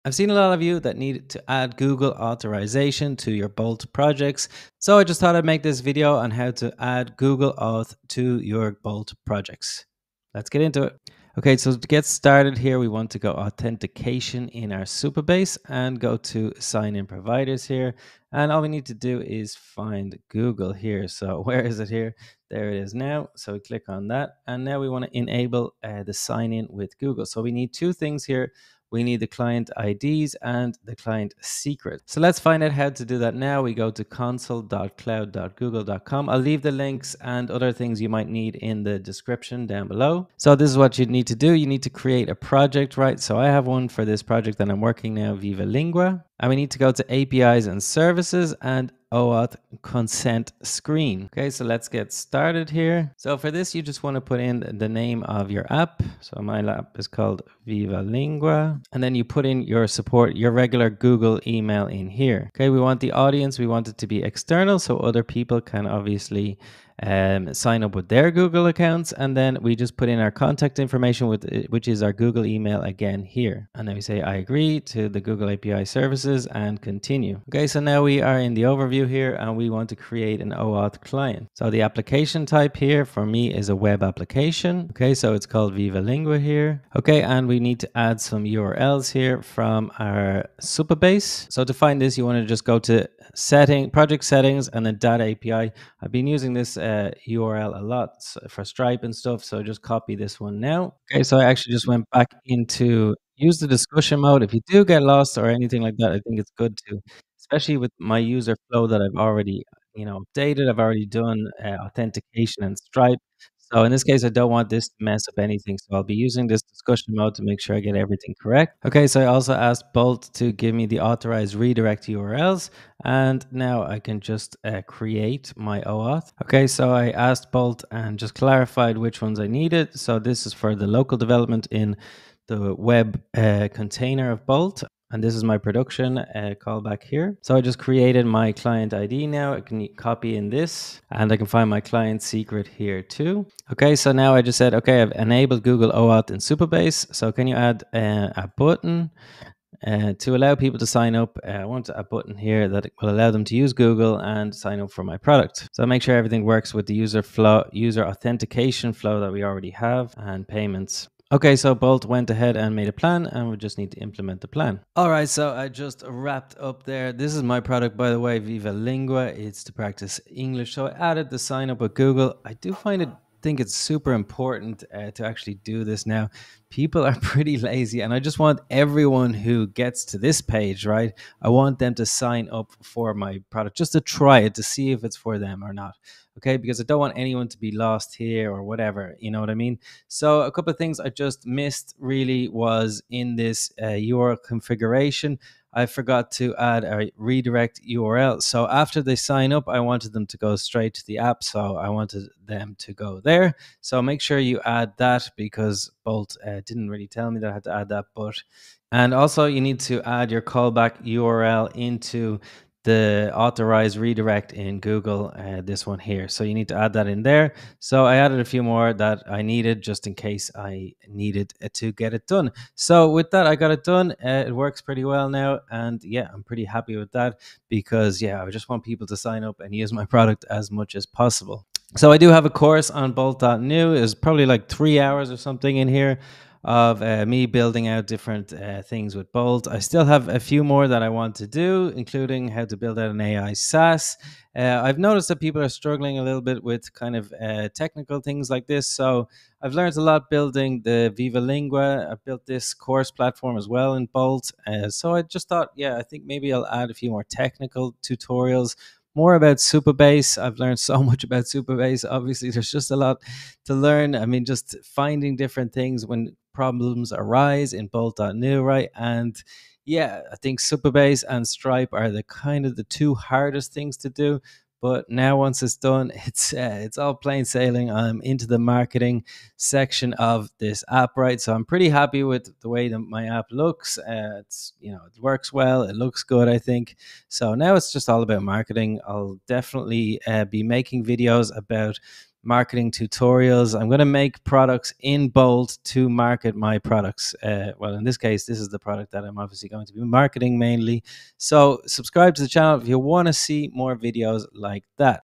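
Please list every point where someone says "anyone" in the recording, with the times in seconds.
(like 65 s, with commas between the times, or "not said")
187 s.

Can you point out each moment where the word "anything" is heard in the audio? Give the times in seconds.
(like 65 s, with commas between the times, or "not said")
105 s, 115 s.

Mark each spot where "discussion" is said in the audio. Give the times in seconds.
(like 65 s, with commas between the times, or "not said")
103 s, 116 s.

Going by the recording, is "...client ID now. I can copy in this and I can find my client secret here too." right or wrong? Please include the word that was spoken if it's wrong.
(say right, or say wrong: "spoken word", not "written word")
right.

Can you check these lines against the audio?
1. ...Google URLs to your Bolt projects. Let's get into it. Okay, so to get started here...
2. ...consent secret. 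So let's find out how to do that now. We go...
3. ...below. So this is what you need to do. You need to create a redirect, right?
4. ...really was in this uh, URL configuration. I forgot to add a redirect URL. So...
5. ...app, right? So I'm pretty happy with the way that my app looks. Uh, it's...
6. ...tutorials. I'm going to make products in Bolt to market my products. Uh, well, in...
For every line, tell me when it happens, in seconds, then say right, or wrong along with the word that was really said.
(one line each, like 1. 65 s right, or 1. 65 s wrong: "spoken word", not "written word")
1. 7 s wrong: "Auth", not "URLs"
2. 30 s wrong: "client", not "consent"
3. 39 s wrong: "project", not "redirect"
4. 191 s right
5. 280 s right
6. 292 s right.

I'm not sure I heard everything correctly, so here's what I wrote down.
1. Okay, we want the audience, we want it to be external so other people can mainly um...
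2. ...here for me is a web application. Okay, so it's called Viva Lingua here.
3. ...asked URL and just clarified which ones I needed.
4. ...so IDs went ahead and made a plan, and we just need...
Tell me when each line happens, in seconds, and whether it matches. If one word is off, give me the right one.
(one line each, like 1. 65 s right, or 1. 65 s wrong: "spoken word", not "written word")
1. 62 s wrong: "obviously", not "mainly"
2. 82 s right
3. 127 s wrong: "Bolt", not "URL"
4. 161 s wrong: "Bolt", not "IDs".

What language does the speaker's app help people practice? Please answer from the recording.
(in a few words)
English.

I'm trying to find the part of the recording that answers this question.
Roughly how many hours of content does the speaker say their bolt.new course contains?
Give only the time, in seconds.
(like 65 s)
234 s.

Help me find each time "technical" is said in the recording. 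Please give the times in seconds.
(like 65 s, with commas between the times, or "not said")
247 s, 257 s.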